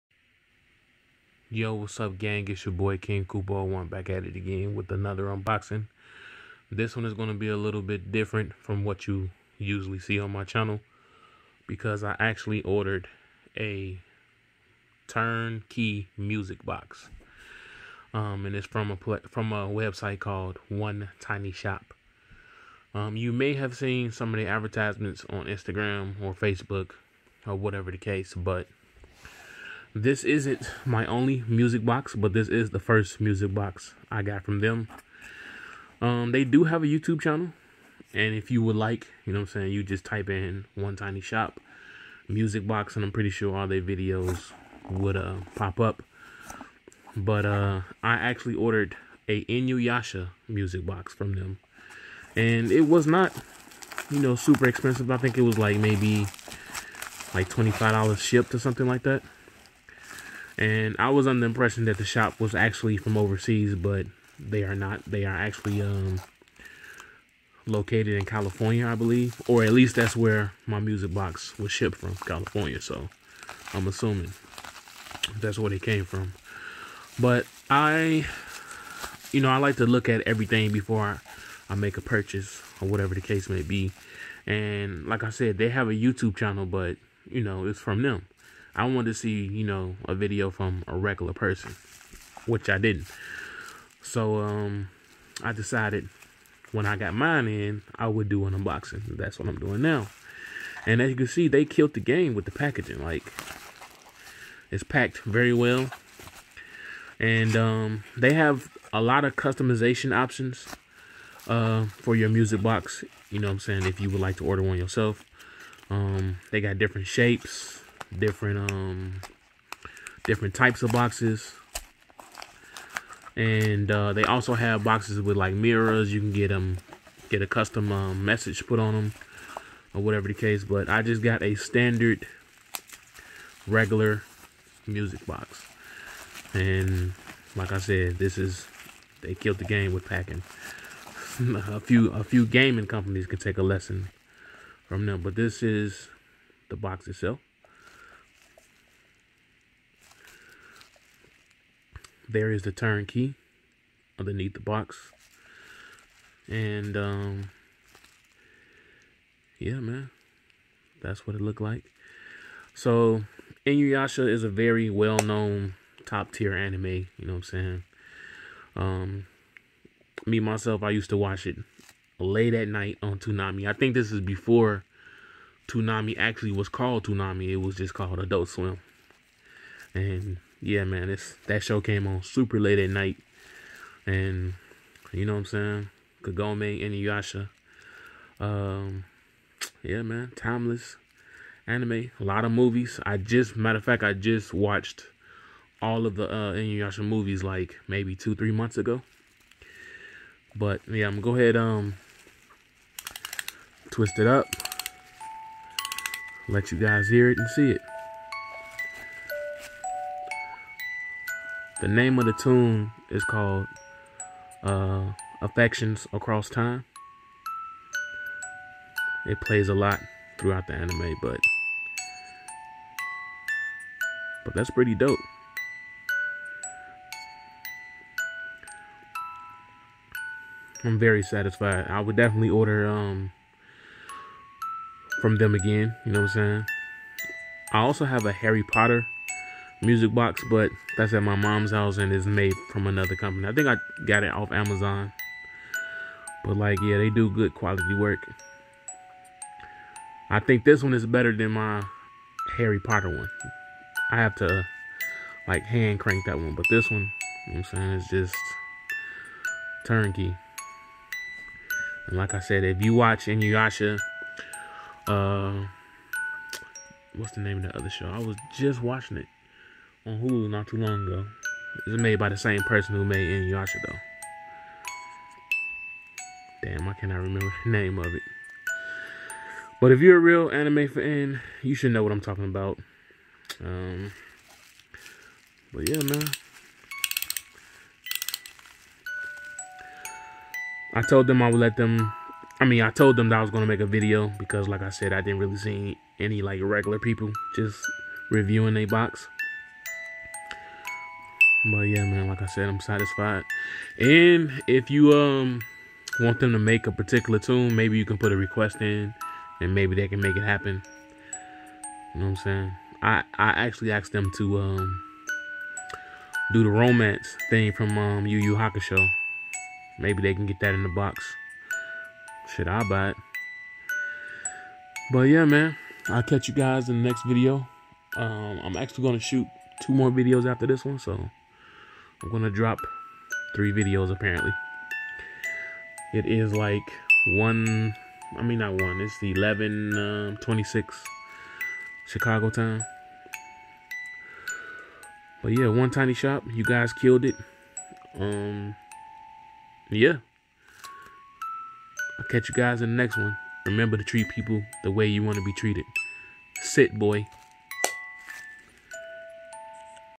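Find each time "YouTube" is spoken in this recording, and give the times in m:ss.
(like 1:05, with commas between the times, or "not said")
0:36, 1:25.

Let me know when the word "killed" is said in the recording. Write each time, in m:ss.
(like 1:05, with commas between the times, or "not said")
1:41, 2:19, 5:46.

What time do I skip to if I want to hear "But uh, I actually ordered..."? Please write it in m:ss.
0:47.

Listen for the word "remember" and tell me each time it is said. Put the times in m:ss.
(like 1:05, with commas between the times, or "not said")
4:37, 5:53.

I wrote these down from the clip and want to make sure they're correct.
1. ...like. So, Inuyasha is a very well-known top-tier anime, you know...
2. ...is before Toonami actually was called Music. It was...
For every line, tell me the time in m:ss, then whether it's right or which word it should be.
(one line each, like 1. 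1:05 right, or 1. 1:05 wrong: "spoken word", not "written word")
1. 2:41 right
2. 2:54 wrong: "Toonami", not "Music".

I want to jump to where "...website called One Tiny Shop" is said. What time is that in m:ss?
0:19.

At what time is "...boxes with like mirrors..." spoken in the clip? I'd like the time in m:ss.
2:04.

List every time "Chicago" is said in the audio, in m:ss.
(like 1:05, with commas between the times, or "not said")
5:42.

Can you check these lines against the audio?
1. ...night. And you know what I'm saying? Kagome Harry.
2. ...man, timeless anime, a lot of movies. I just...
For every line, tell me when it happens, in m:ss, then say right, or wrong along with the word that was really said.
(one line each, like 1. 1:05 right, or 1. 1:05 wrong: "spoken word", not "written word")
1. 3:02 wrong: "Inuyasha", not "Harry"
2. 3:10 right.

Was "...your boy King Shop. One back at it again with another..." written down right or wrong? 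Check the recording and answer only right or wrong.
wrong.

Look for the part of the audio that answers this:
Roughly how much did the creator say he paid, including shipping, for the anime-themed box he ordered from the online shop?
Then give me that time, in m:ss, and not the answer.
0:57.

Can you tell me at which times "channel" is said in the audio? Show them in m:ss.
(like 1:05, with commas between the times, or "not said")
0:10, 0:37, 1:26.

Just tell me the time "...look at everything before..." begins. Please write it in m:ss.
1:19.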